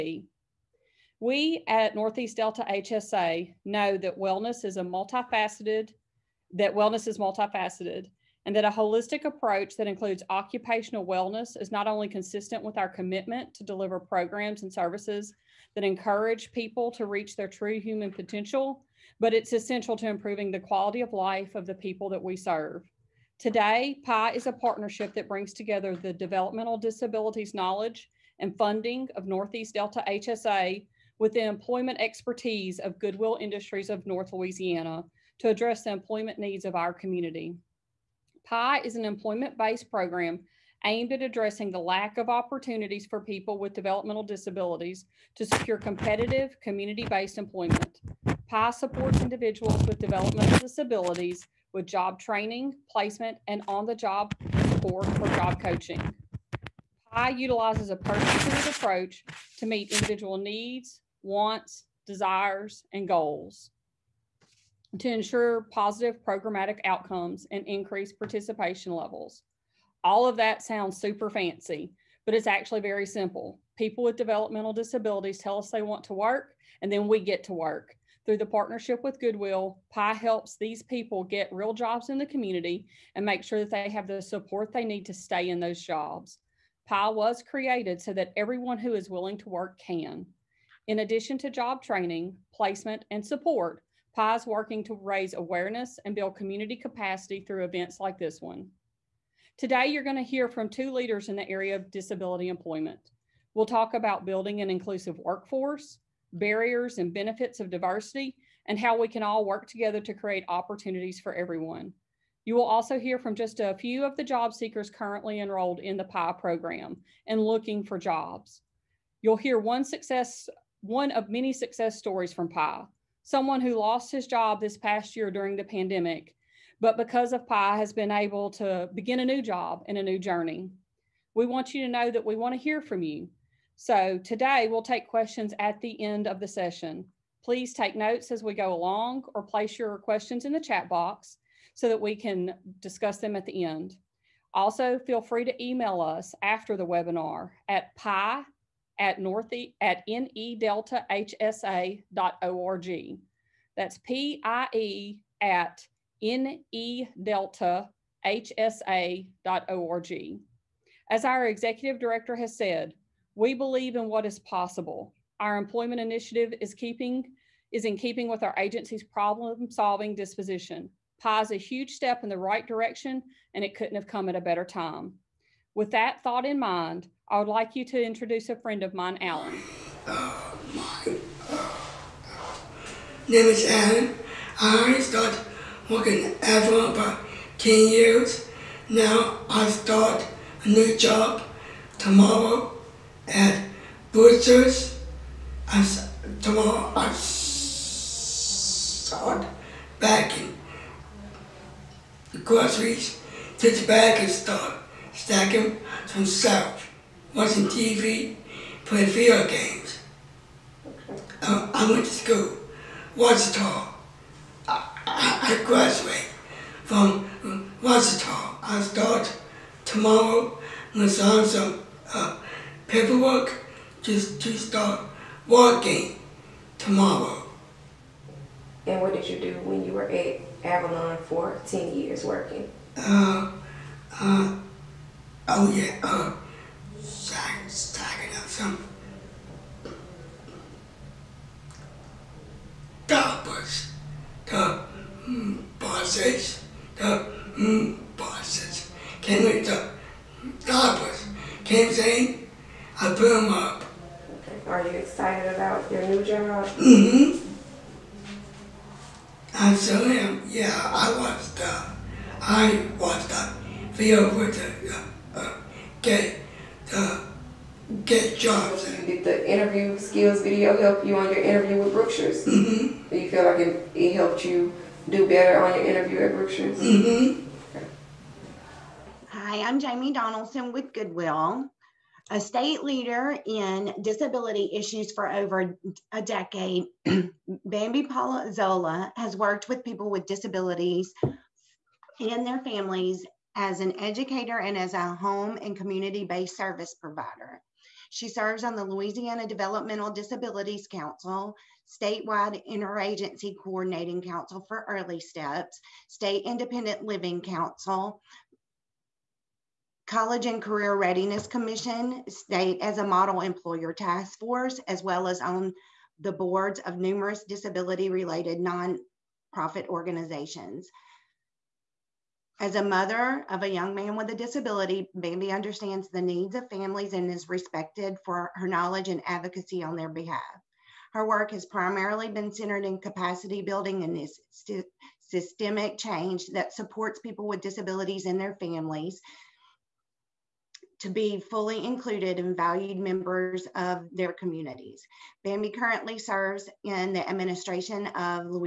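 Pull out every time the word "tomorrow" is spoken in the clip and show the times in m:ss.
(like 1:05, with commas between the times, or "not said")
3:11, 3:16, 3:39, 3:46.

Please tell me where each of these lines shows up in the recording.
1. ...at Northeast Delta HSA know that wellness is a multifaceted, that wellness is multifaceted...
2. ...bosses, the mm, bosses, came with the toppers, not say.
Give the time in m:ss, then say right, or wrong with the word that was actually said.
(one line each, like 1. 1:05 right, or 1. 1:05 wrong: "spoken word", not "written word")
1. 0:01 right
2. 4:05 right.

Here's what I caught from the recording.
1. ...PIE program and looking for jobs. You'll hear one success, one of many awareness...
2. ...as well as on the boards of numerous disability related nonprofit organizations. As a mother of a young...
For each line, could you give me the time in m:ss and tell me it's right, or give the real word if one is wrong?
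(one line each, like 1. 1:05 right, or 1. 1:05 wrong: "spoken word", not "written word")
1. 1:56 wrong: "success", not "awareness"
2. 5:14 right.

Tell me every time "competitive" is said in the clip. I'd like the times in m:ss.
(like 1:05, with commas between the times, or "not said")
0:45.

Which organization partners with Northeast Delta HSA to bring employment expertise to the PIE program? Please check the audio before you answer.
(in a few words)
Goodwill Industries of North Louisiana.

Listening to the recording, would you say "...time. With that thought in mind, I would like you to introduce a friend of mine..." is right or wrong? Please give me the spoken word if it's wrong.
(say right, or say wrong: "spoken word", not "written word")
right.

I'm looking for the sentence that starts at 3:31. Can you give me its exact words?
Um, I went to school, Ouachita.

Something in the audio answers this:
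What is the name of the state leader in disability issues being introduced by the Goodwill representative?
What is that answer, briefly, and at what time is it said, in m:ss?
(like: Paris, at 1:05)
Bambi Zola, at 4:47.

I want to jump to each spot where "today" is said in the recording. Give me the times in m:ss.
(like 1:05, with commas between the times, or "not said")
0:23, 1:39, 2:14.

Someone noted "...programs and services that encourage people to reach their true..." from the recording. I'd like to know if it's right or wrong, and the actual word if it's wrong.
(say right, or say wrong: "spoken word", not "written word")
right.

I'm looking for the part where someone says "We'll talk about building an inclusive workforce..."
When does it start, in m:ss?
1:43.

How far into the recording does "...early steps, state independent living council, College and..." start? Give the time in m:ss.
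5:04.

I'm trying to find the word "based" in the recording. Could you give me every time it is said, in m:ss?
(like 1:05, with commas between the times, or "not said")
0:39, 0:46, 4:56.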